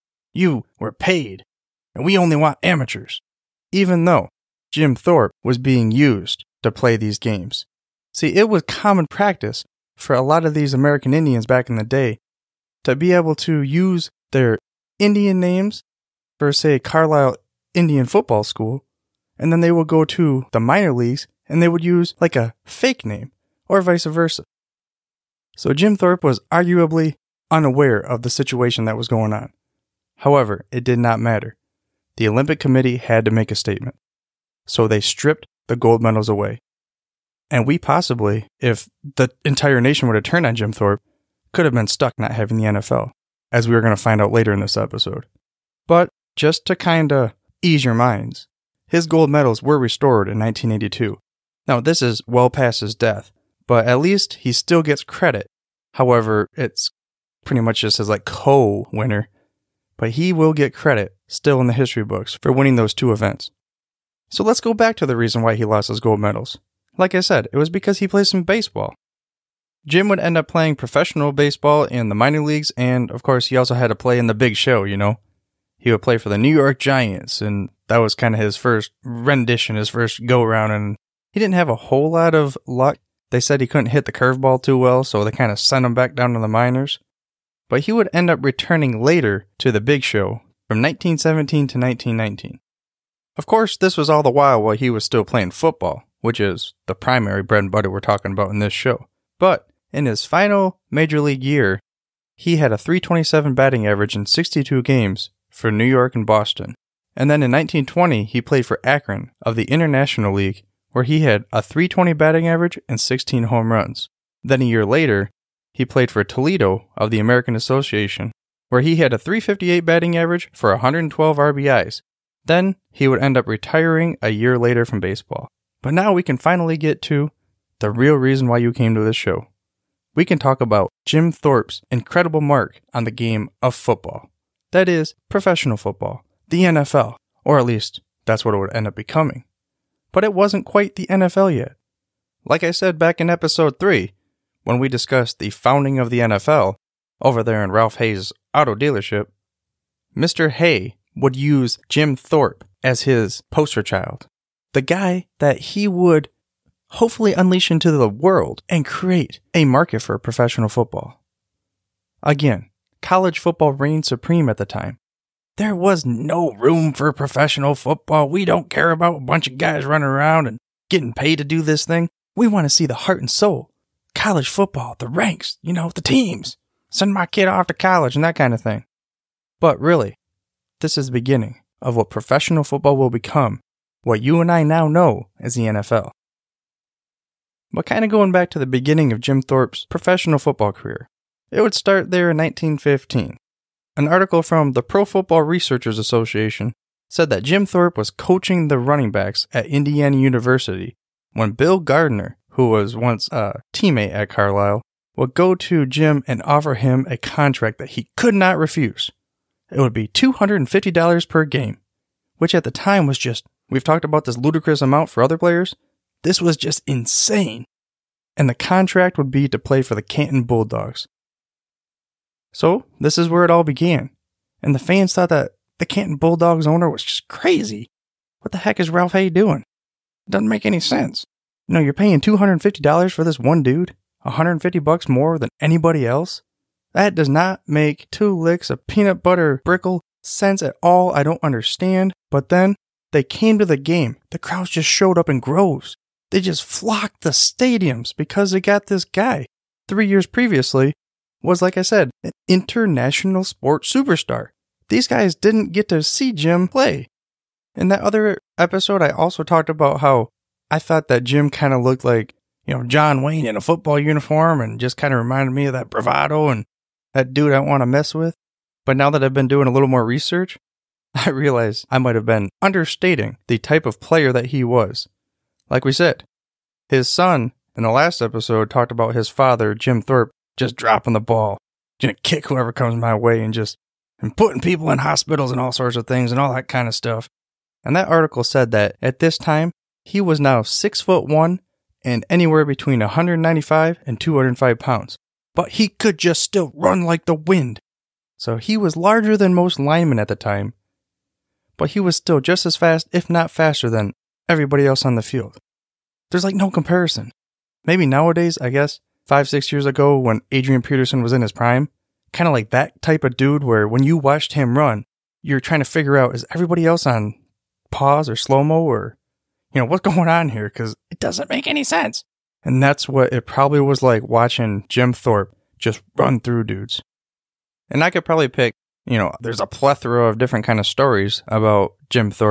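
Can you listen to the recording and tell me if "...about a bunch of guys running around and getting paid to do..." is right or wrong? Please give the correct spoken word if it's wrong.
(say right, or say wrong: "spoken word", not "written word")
right.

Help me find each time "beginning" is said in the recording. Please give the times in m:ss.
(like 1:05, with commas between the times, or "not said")
3:01, 3:08.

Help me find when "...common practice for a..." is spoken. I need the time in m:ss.
0:08.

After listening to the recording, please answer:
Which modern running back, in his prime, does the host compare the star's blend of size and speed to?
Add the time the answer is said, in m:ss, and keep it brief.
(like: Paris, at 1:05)
Adrian Peterson, at 5:10.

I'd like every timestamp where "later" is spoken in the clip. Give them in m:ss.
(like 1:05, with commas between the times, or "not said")
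0:44, 1:29, 1:54, 2:04.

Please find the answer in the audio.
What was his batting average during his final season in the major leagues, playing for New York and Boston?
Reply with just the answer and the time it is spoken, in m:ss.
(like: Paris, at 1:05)
.327, at 1:42.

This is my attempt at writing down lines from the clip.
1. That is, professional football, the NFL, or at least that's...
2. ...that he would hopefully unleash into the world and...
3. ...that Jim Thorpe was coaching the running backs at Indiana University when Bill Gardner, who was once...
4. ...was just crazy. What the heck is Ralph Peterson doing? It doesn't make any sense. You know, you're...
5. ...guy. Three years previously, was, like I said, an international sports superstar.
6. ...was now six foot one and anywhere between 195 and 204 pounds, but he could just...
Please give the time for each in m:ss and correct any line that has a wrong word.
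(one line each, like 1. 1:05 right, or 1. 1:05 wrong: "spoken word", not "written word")
1. 2:14 right
2. 2:35 right
3. 3:17 right
4. 3:46 wrong: "Hay", not "Peterson"
5. 4:09 right
6. 4:50 wrong: "205", not "204".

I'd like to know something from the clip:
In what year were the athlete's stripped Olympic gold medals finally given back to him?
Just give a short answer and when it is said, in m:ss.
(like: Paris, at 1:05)
1982, at 0:50.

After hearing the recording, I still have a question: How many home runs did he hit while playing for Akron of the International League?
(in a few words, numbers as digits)
16.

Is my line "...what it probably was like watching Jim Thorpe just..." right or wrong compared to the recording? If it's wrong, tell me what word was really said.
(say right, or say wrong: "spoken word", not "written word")
right.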